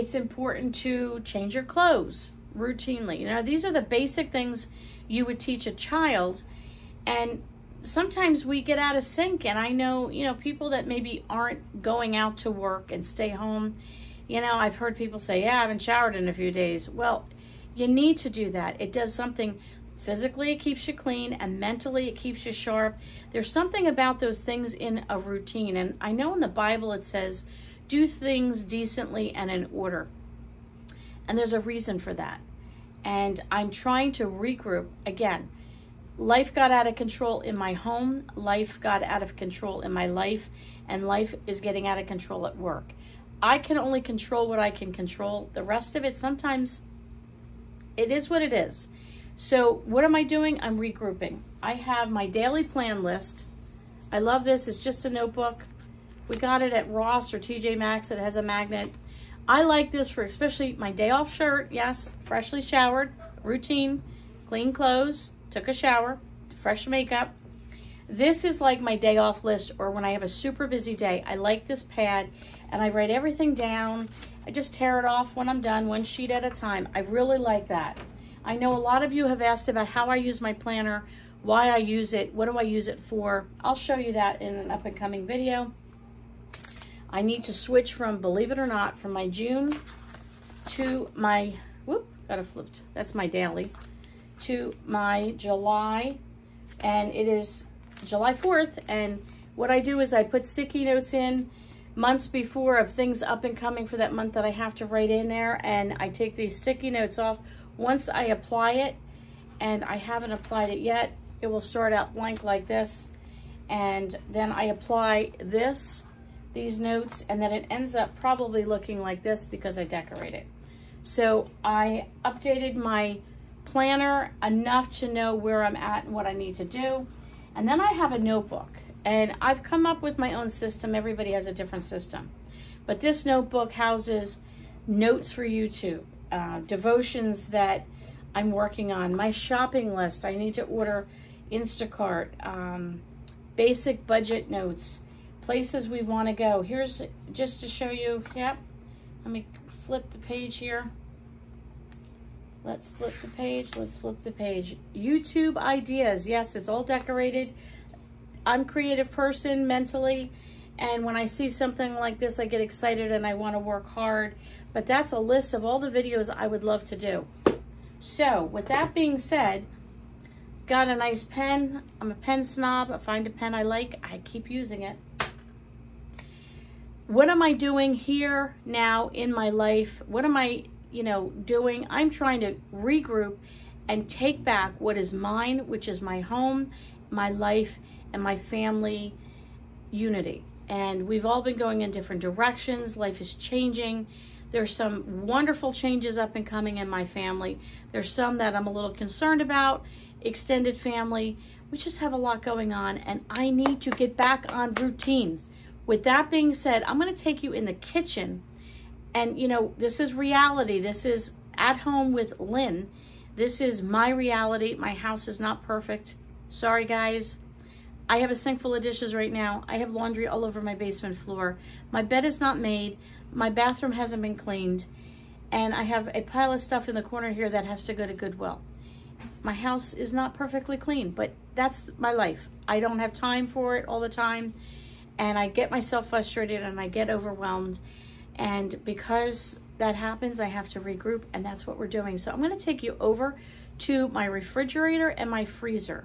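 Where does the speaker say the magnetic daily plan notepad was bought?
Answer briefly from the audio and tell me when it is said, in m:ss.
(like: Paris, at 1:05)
Ross or TJ Maxx, at 0:56.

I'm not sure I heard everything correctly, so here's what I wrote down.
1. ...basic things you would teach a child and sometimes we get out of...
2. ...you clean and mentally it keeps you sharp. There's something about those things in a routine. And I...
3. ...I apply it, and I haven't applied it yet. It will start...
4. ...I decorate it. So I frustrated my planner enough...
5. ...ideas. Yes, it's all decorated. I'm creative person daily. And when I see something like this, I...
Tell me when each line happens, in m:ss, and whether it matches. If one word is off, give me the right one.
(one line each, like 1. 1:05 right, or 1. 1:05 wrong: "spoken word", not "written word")
1. 0:03 right
2. 0:20 right
3. 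1:48 right
4. 1:59 wrong: "updated", not "frustrated"
5. 2:35 wrong: "mentally", not "daily".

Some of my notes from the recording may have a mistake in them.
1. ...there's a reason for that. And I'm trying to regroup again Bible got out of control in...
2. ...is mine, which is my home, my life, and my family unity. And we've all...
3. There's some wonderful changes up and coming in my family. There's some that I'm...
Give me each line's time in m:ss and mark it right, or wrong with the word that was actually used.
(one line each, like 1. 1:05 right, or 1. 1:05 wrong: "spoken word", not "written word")
1. 0:31 wrong: "Life", not "Bible"
2. 3:04 right
3. 3:14 right.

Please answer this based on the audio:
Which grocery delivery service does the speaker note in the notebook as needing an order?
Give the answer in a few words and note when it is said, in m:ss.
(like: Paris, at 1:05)
Instacart, at 2:21.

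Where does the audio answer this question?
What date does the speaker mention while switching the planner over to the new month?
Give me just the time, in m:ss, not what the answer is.
1:38.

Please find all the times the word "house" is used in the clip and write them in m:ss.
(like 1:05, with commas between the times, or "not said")
2:13, 3:34, 3:49.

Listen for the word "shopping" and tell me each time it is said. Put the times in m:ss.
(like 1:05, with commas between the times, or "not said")
2:19.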